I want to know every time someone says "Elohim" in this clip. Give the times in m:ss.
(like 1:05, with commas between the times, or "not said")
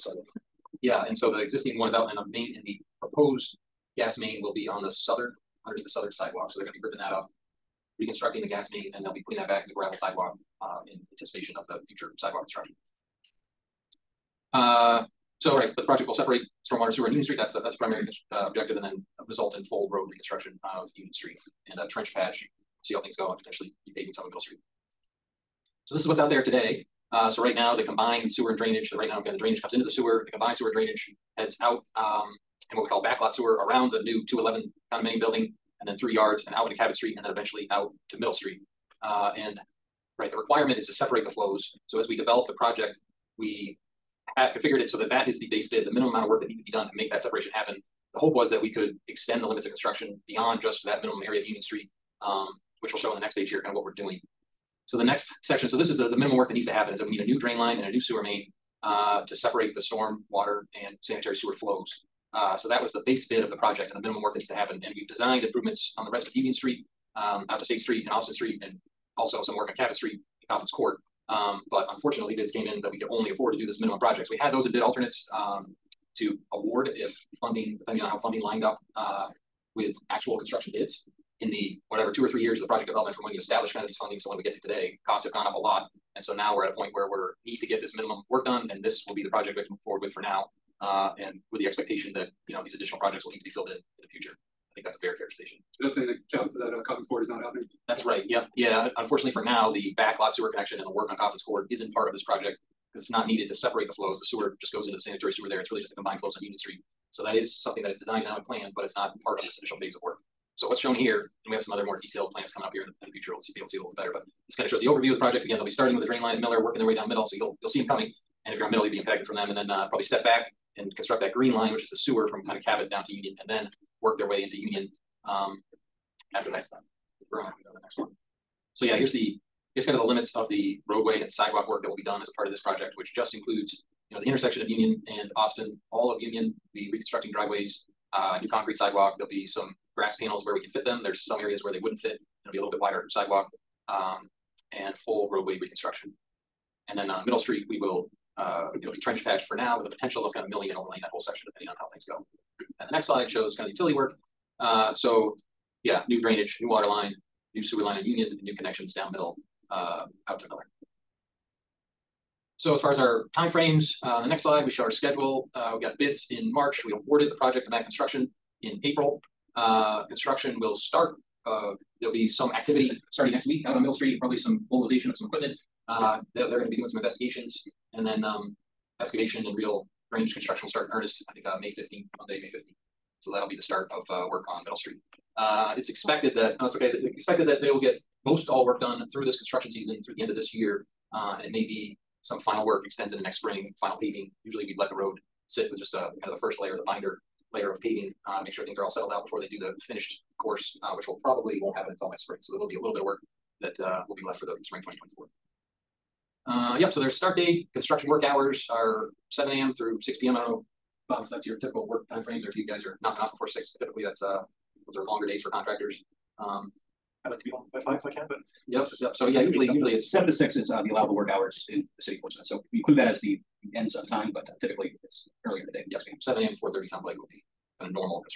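not said.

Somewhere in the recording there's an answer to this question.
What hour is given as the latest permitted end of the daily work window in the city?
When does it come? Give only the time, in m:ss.
3:30.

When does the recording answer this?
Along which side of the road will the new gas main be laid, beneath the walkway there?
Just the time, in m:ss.
0:05.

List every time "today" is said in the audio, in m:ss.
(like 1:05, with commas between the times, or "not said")
0:26, 1:24.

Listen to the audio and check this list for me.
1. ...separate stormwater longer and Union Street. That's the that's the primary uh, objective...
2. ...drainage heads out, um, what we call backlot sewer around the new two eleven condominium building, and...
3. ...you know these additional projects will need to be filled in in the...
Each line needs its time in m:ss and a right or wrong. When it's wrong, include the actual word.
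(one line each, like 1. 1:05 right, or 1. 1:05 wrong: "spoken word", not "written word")
1. 0:16 wrong: "sewer", not "longer"
2. 0:30 right
3. 1:32 right.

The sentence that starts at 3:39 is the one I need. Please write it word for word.
So yeah, usually usually it's seven to six is uh, the allowable work hours in the city of Portsmouth.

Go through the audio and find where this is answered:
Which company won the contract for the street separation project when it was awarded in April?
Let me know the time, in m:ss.
2:47.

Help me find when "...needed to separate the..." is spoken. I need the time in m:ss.
1:43.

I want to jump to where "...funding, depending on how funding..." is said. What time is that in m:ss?
1:17.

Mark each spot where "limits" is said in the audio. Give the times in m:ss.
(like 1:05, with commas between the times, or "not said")
0:49, 2:10.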